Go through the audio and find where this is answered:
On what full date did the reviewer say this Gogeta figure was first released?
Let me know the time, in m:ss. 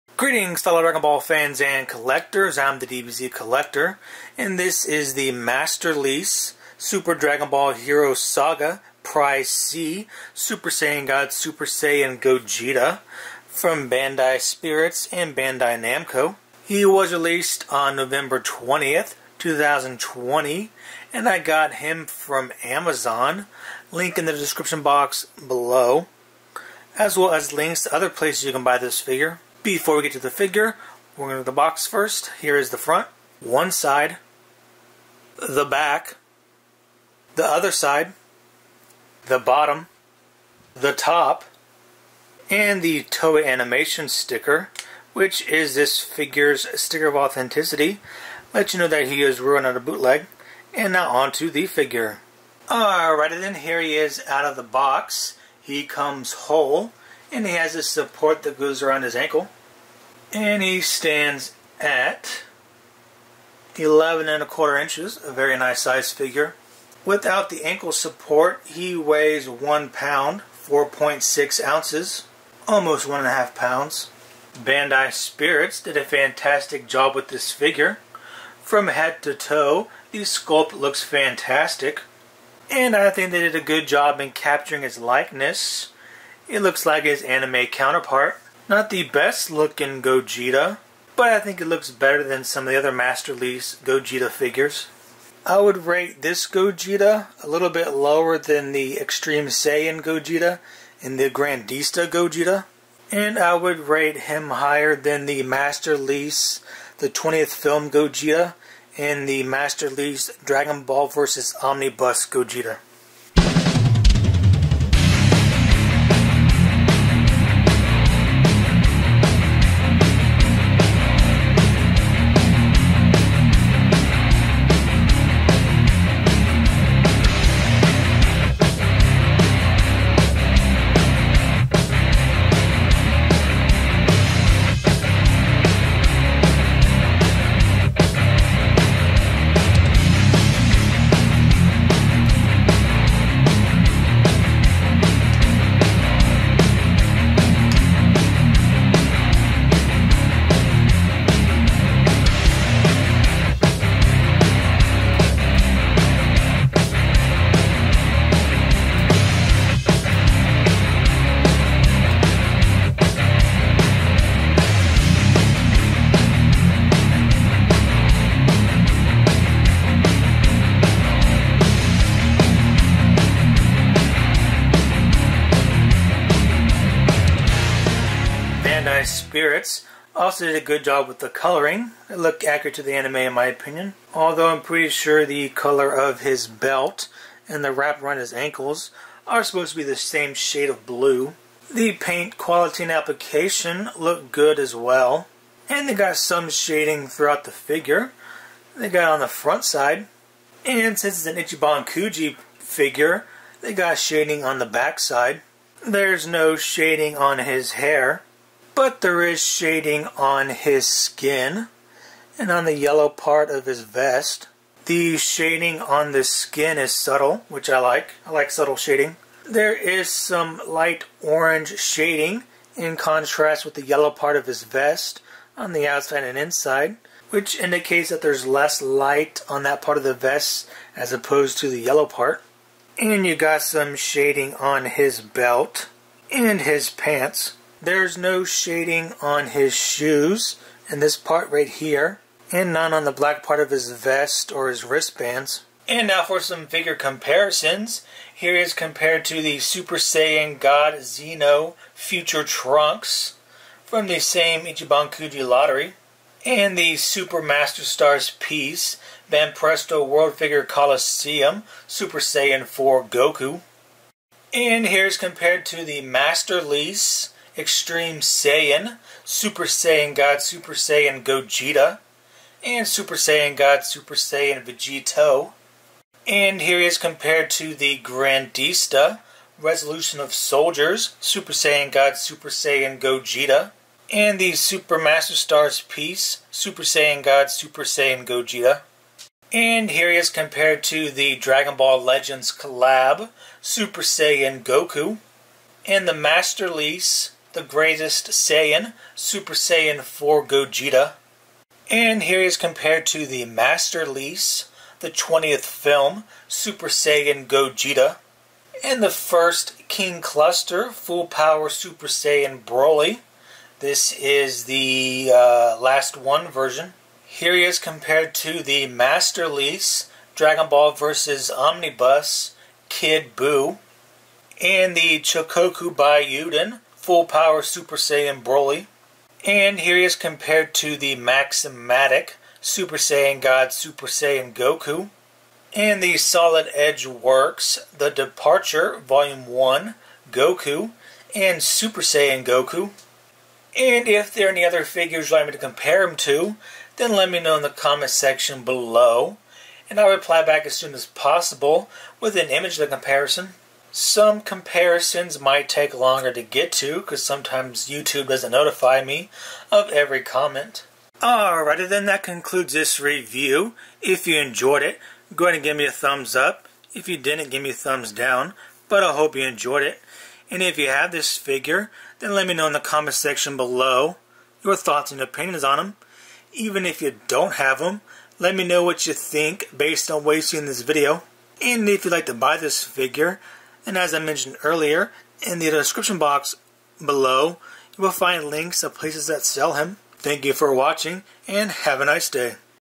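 0:17.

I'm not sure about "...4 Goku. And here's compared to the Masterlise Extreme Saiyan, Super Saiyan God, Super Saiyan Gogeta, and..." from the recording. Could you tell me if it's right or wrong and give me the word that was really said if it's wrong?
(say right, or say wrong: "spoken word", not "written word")
right.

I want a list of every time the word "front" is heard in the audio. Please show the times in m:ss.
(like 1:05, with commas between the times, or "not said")
0:32, 3:19.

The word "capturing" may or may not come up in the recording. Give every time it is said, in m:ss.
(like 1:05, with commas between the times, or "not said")
1:24.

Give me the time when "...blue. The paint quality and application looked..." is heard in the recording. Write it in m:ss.
3:10.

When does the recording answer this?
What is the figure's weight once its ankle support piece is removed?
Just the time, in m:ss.
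1:09.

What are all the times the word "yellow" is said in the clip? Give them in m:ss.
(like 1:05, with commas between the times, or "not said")
3:32, 3:43, 3:51.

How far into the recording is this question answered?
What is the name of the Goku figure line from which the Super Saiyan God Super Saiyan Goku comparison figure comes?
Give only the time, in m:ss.
5:31.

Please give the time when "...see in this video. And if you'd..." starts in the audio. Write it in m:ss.
6:20.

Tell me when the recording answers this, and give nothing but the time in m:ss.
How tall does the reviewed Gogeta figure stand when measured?
1:03.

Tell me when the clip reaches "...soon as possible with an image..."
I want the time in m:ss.
5:50.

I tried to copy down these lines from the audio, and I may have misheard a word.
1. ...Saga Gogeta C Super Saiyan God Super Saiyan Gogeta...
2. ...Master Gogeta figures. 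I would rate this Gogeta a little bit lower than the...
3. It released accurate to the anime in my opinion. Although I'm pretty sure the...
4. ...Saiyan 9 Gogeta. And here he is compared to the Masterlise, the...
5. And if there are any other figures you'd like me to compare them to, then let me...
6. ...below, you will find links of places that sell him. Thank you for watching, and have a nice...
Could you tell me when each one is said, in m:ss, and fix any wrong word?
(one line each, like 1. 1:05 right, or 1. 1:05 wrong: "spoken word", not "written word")
1. 0:08 wrong: "Prize", not "Gogeta"
2. 1:32 right
3. 3:02 wrong: "looked", not "released"
4. 4:59 wrong: "4", not "9"
5. 5:43 right
6. 6:27 right.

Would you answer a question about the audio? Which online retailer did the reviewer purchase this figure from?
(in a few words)
Amazon.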